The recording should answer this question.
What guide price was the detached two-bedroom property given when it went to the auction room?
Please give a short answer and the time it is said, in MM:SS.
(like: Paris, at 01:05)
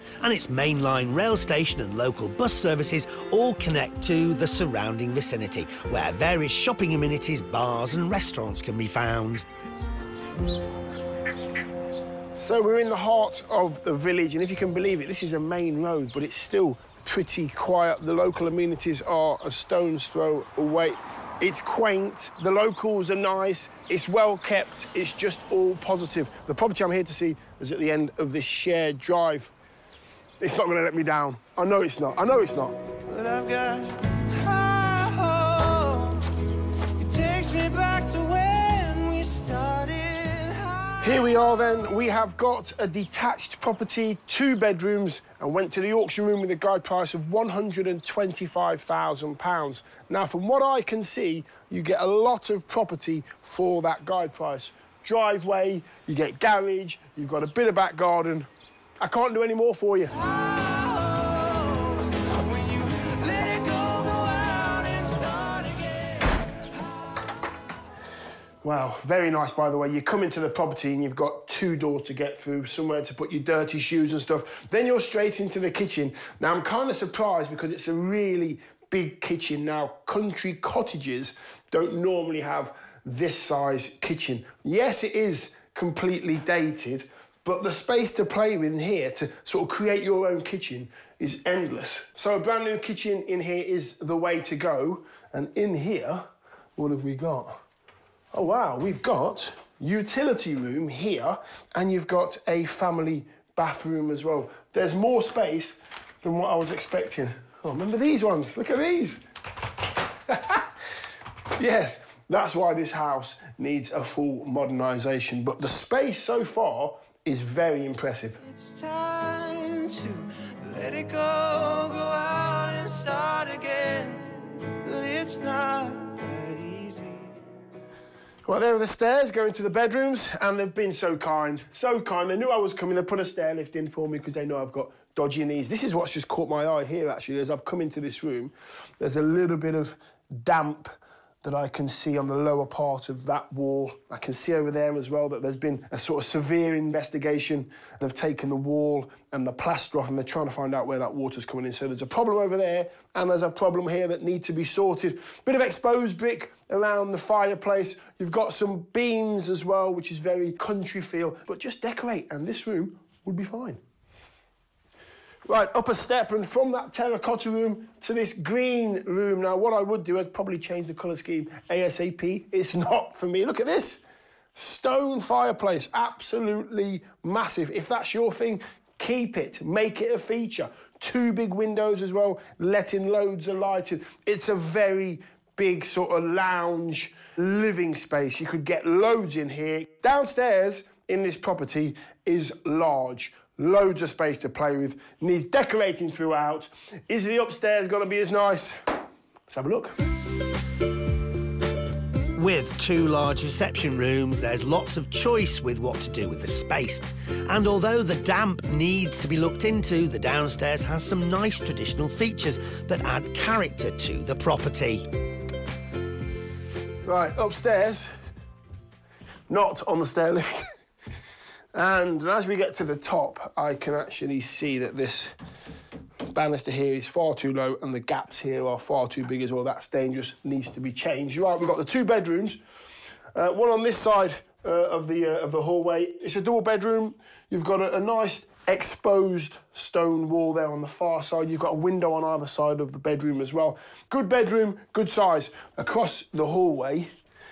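£125,000, at 00:47.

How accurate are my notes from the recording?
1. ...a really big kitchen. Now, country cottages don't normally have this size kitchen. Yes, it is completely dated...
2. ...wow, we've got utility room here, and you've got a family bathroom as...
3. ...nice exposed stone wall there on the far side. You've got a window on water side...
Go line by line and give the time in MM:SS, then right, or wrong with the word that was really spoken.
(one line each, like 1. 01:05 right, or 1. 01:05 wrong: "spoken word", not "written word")
1. 01:17 right
2. 01:38 right
3. 03:57 wrong: "either", not "water".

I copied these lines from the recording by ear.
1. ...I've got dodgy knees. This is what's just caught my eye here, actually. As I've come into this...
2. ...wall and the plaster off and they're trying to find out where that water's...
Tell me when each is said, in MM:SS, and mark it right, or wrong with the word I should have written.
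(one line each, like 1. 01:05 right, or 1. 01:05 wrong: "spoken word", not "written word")
1. 02:14 right
2. 02:28 right.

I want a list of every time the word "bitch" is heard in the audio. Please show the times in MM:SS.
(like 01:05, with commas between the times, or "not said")
not said.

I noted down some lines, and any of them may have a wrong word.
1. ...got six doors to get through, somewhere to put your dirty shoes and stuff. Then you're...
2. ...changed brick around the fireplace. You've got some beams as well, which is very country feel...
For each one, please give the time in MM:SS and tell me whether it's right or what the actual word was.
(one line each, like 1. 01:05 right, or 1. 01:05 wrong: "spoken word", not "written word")
1. 01:11 wrong: "two", not "six"
2. 02:35 wrong: "exposed", not "changed".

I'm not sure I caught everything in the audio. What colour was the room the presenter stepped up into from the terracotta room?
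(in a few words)
green.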